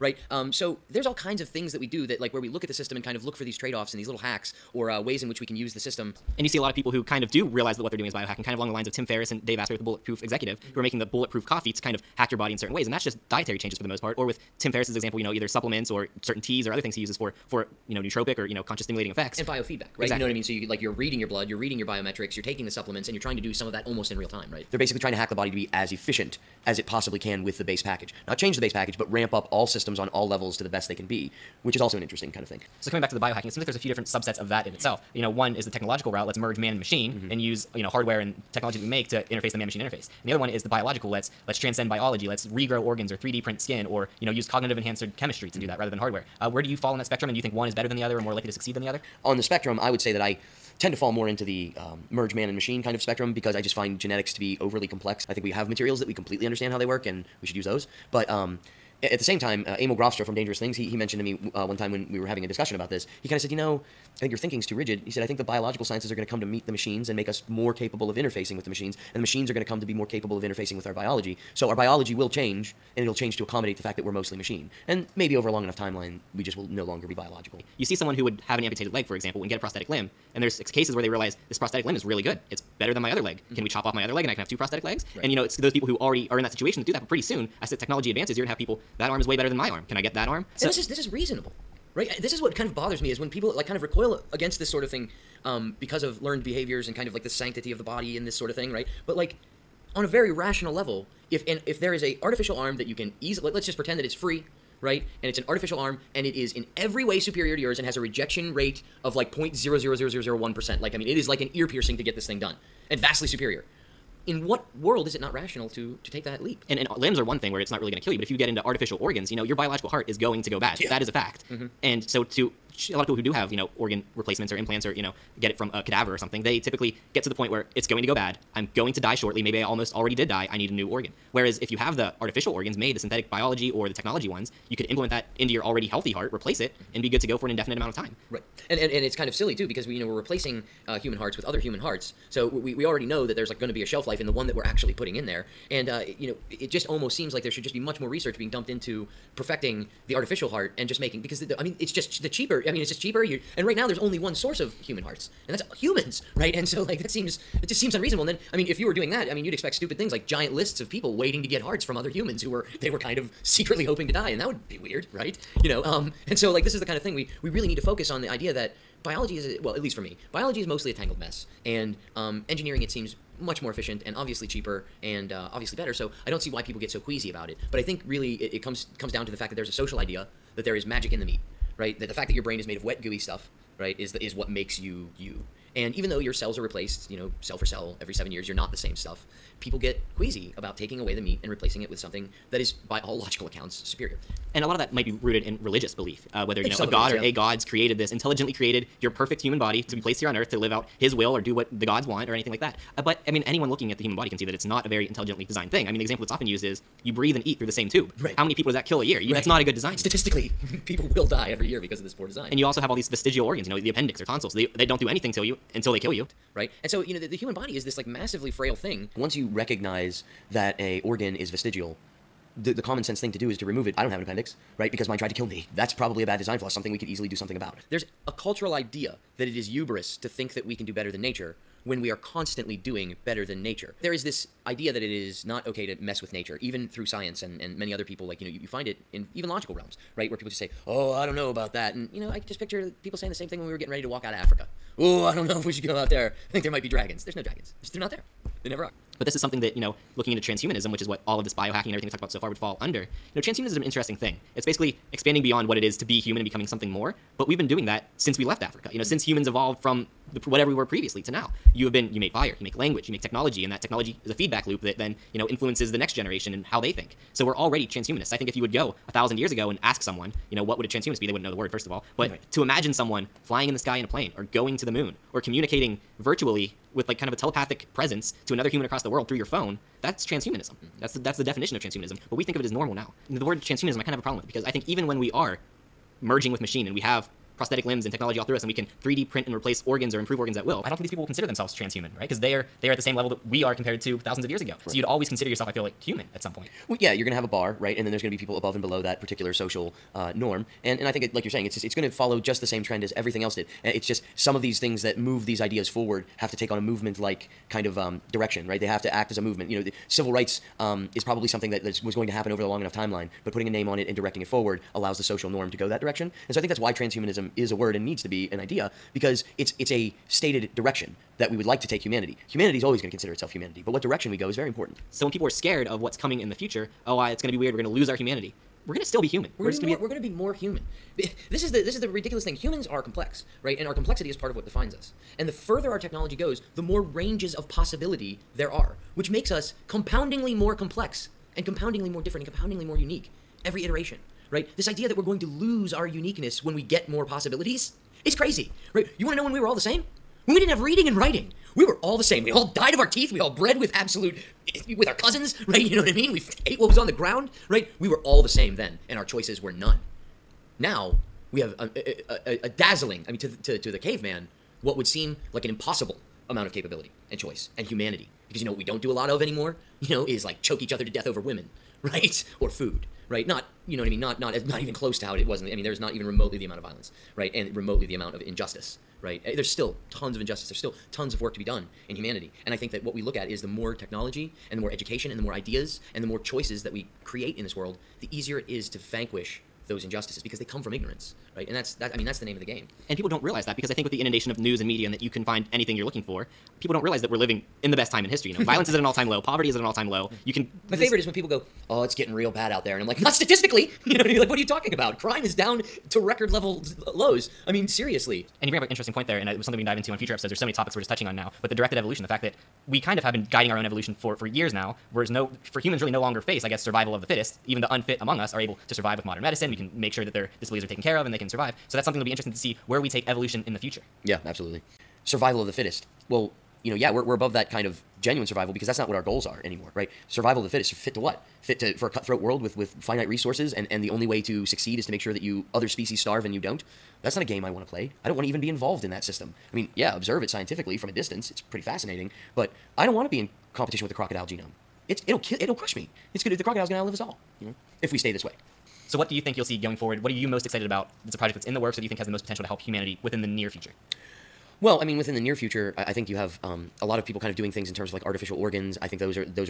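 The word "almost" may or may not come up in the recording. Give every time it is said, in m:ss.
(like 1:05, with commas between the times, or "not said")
0:23, 2:09, 2:26.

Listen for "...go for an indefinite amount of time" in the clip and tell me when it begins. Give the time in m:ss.
2:17.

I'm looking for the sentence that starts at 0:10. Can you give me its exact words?
who are making the bulletproof coffee to kind of hack your body in certain ways.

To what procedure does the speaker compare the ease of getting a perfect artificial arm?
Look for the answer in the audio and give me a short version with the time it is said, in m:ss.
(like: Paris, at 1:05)
an ear piercing, at 1:51.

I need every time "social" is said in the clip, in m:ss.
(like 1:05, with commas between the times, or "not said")
2:59, 4:59, 5:15.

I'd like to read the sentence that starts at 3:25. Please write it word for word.
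I mean, the example that's often used is you breathe and eat through the same tube.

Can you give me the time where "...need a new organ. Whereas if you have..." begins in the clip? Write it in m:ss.
2:10.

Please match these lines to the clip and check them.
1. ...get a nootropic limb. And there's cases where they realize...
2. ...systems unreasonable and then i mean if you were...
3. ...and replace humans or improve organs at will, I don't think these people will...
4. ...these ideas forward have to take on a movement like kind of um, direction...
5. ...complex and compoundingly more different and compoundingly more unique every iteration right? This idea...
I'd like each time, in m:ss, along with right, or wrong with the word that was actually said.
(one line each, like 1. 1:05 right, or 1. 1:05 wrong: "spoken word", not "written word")
1. 1:19 wrong: "prosthetic", not "nootropic"
2. 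2:37 wrong: "seems", not "systems"
3. 4:49 wrong: "organs", not "humans"
4. 5:05 right
5. 5:40 right.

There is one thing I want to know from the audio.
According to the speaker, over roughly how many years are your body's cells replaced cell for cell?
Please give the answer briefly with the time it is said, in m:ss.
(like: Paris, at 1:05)
7 years, at 3:08.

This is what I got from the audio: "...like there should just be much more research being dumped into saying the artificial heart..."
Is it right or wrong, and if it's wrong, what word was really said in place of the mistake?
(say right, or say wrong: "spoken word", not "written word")
wrong: "perfecting", not "saying".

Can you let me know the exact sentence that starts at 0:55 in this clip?
I think we have materials that we completely understand how they work and we should use those.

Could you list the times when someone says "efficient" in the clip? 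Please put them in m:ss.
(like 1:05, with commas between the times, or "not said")
0:25, 2:53.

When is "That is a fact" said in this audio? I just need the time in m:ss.
2:00.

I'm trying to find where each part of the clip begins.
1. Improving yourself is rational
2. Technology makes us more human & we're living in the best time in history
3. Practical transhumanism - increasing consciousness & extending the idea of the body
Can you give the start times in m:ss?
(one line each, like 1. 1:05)
1. 1:16
2. 5:24
3. 7:28.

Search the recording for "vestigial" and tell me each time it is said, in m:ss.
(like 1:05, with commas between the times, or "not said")
3:33, 3:41.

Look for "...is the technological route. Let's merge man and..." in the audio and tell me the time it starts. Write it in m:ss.
0:35.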